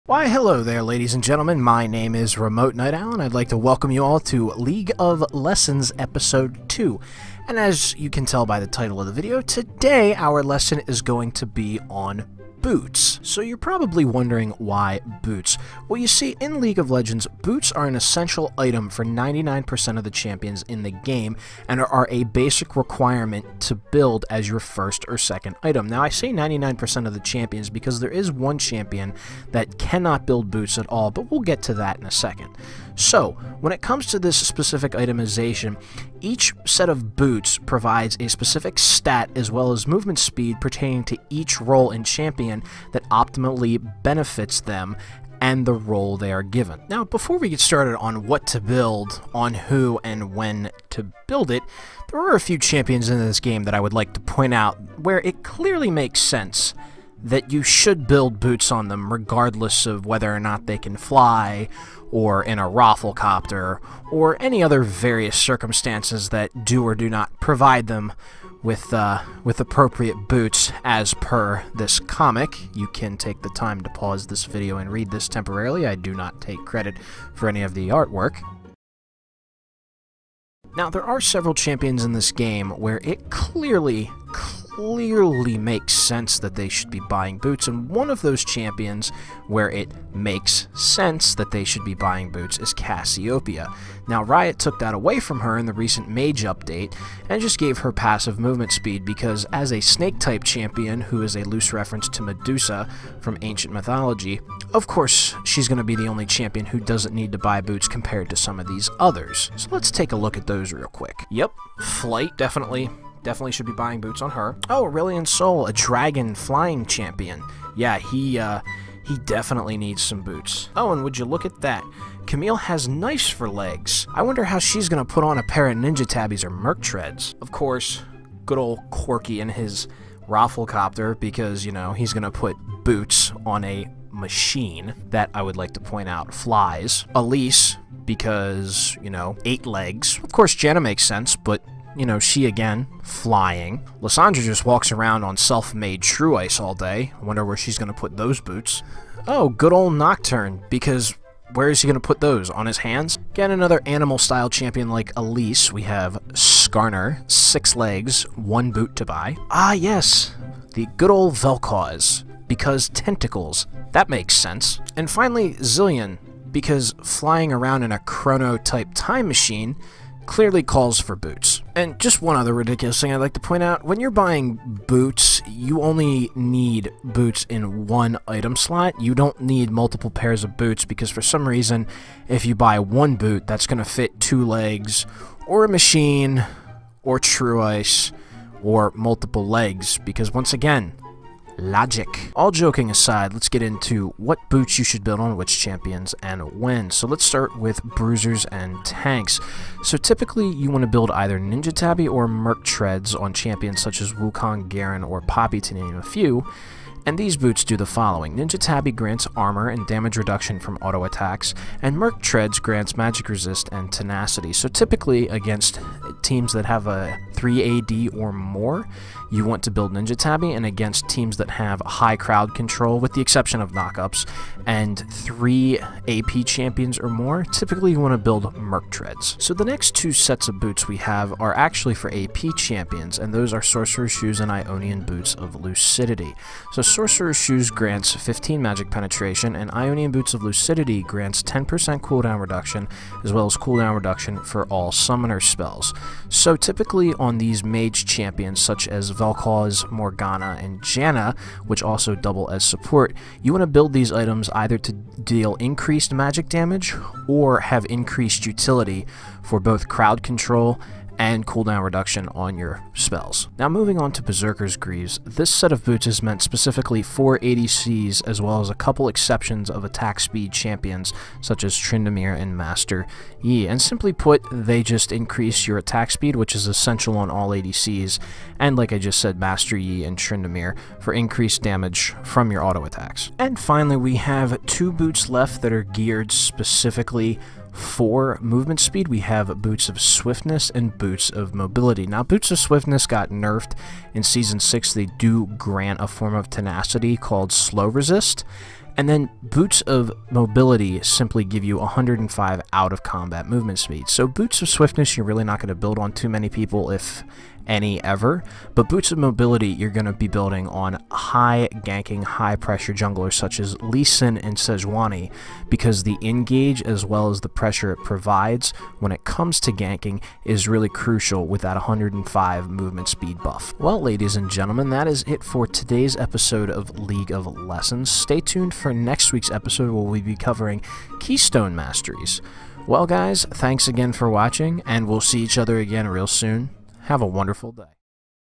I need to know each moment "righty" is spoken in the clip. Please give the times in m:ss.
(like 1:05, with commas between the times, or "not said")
not said.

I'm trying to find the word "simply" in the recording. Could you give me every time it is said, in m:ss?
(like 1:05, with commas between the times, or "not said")
4:33, 5:01.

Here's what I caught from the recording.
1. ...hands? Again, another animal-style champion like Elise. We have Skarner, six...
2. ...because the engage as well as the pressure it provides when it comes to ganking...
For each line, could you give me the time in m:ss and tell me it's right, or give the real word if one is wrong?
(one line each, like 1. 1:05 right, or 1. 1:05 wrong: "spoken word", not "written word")
1. 2:32 right
2. 5:15 right.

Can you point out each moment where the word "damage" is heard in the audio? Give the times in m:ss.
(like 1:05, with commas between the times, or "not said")
3:29, 4:16, 4:41.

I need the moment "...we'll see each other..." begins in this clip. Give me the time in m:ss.
5:35.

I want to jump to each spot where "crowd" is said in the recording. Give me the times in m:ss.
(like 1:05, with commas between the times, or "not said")
3:42, 4:19.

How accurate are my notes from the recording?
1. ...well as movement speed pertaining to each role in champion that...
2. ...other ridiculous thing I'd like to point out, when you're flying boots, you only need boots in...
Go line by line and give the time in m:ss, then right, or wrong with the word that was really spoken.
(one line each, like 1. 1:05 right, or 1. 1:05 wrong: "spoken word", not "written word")
1. 0:39 right
2. 2:52 wrong: "buying", not "flying".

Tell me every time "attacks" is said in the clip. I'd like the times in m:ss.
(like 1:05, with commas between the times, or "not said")
3:31, 4:29, 4:35, 4:42.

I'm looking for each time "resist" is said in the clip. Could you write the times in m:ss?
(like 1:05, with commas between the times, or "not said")
3:33, 4:57.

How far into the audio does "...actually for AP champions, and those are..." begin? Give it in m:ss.
3:51.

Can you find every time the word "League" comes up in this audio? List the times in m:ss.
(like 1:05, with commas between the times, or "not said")
0:04, 0:16, 5:26.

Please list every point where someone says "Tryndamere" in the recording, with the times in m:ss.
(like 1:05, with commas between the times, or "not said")
4:31, 4:40.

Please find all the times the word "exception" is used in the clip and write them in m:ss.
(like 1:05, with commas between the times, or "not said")
3:43, 4:29.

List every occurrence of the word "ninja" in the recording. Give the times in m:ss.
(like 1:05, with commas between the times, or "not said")
2:05, 3:21, 3:28, 3:39.